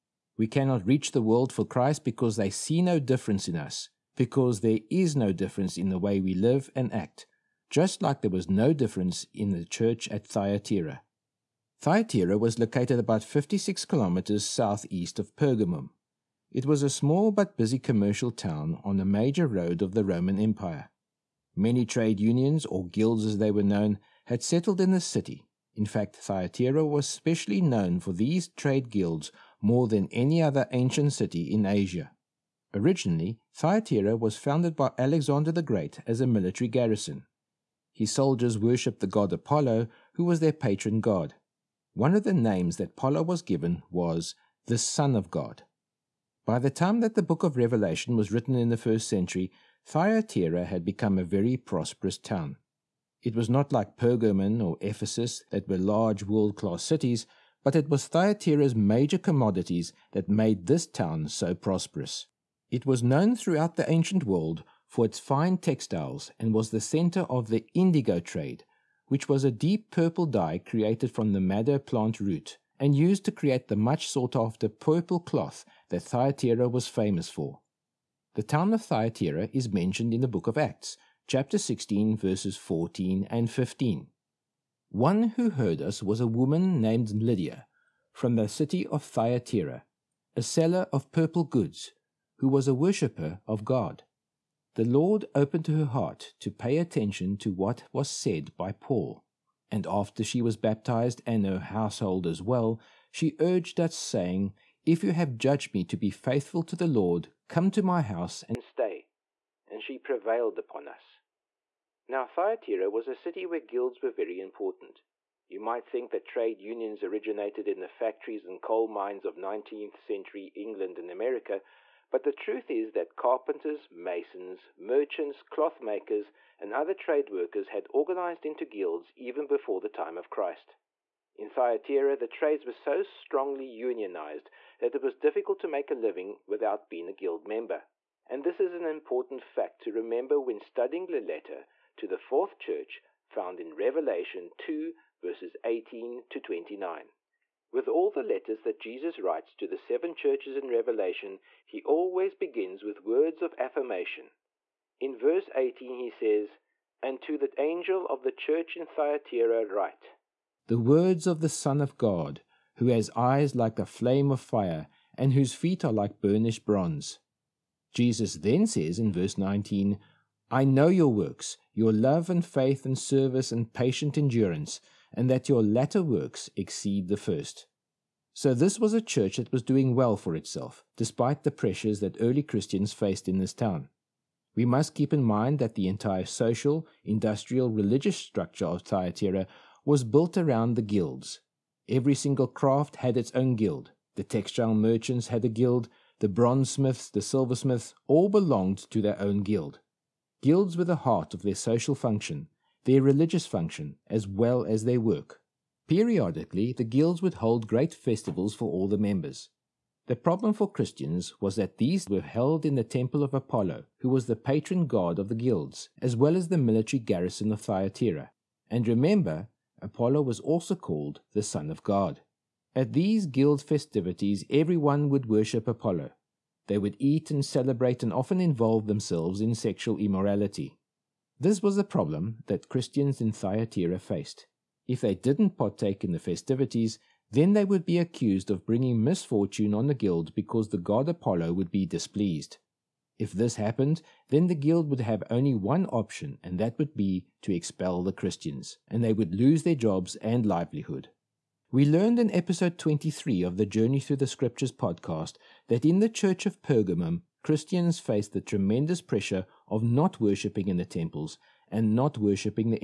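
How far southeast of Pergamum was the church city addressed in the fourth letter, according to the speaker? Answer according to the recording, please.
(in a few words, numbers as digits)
56 kilometers.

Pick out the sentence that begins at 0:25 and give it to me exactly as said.
In fact, Thyatira was specially known for these trade guilds more than any other ancient city in Asia.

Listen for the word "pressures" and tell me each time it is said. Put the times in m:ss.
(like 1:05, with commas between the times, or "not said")
3:01, 4:19.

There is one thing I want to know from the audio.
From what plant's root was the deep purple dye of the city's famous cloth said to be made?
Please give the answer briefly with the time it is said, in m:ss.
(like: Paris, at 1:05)
madder plant, at 1:11.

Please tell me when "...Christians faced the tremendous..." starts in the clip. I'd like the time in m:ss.
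4:17.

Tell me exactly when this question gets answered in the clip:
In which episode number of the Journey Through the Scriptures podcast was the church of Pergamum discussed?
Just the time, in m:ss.
4:12.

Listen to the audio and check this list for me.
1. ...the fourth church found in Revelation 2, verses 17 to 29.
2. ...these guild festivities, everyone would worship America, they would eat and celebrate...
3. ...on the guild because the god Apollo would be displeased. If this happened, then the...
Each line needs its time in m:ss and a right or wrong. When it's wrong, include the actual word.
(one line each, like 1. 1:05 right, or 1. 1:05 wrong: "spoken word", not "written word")
1. 2:22 wrong: "18", not "17"
2. 3:42 wrong: "Apollo", not "America"
3. 3:59 right.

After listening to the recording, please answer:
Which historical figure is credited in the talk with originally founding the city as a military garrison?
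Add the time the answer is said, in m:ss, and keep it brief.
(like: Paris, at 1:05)
Alexander the Great, at 0:34.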